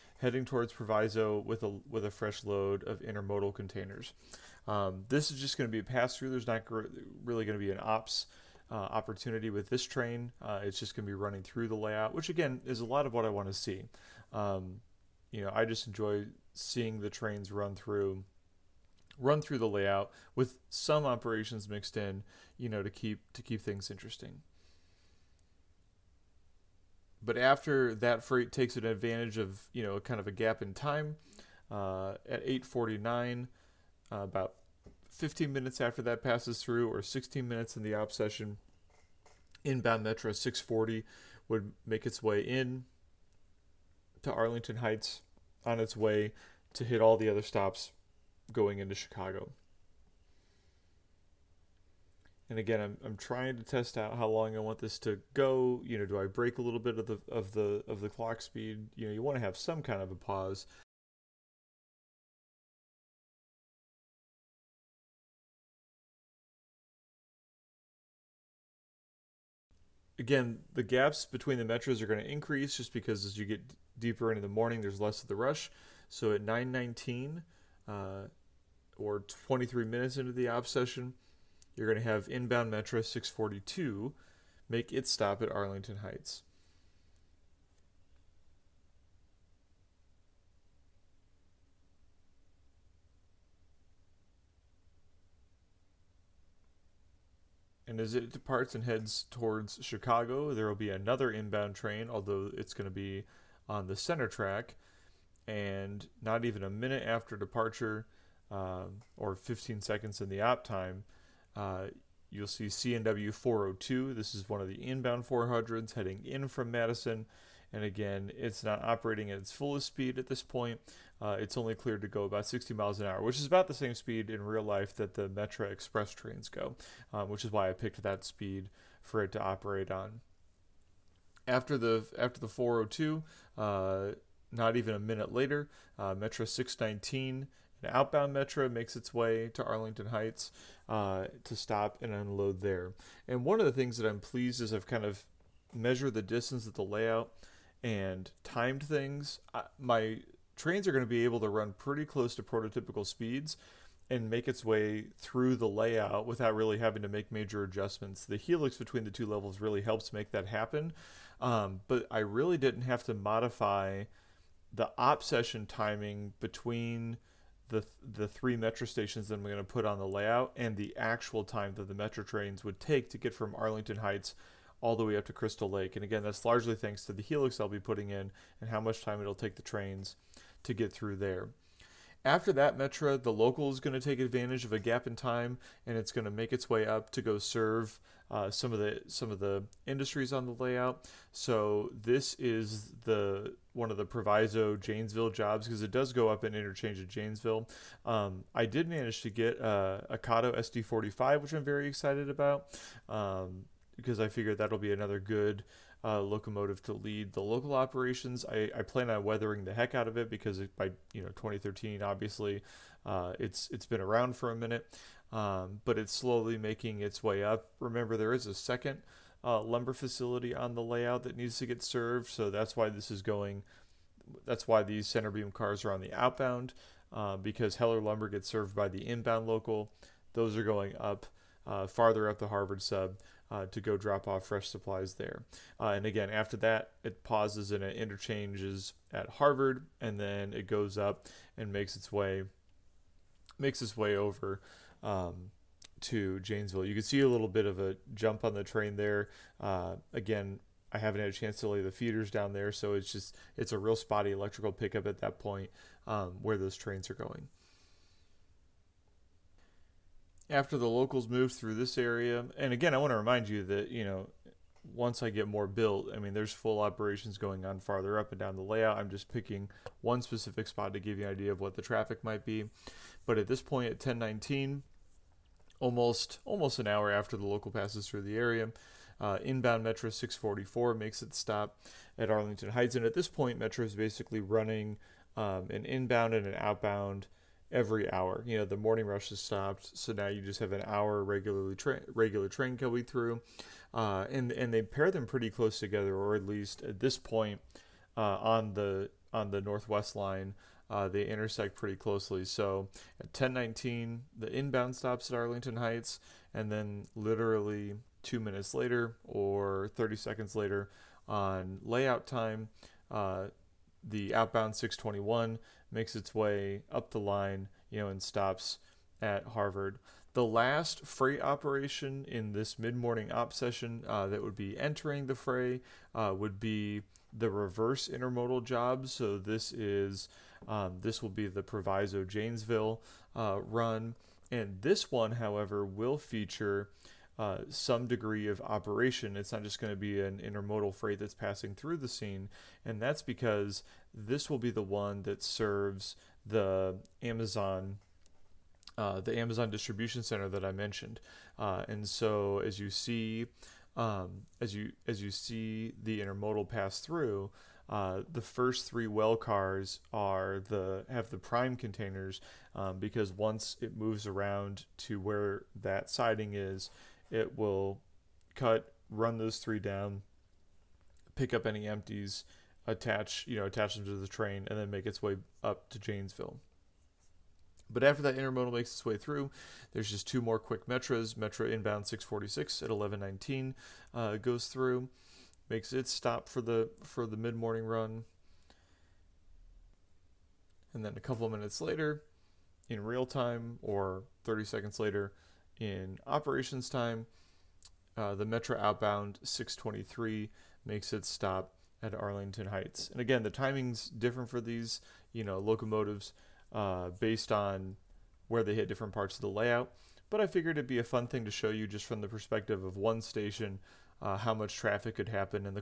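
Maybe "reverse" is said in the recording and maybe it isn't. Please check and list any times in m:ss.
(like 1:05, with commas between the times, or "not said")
5:27.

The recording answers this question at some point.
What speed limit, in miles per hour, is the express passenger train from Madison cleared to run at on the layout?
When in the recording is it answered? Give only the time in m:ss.
2:02.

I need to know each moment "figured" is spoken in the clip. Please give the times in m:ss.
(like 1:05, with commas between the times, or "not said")
3:24, 6:50.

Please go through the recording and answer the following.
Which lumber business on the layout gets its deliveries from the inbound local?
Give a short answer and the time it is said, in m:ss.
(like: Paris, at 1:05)
Heller Lumber, at 3:47.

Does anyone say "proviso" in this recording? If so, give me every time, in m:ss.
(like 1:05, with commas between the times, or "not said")
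0:00, 3:14, 5:31.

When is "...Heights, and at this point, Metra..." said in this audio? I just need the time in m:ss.
4:42.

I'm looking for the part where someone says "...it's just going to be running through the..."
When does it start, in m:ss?
0:10.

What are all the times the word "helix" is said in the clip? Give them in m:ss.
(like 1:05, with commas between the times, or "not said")
2:38, 2:57.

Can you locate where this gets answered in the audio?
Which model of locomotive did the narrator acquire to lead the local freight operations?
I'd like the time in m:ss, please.
3:20.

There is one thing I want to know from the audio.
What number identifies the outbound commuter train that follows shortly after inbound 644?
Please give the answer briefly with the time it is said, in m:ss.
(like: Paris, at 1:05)
621, at 5:14.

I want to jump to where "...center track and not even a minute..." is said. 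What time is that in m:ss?
1:43.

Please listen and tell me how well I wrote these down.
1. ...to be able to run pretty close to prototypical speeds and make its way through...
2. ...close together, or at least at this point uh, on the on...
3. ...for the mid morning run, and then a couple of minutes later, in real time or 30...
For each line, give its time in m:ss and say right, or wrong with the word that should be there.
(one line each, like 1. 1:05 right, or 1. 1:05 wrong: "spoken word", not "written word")
1. 2:31 right
2. 4:55 right
3. 6:27 right.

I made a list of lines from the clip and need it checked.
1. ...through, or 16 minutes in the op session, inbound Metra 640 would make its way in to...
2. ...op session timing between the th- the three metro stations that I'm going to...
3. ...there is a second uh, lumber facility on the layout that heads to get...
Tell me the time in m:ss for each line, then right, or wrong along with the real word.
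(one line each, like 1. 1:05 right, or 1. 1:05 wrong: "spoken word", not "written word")
1. 0:36 right
2. 2:44 right
3. 3:38 wrong: "needs", not "heads".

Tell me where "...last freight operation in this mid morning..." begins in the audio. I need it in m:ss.
5:20.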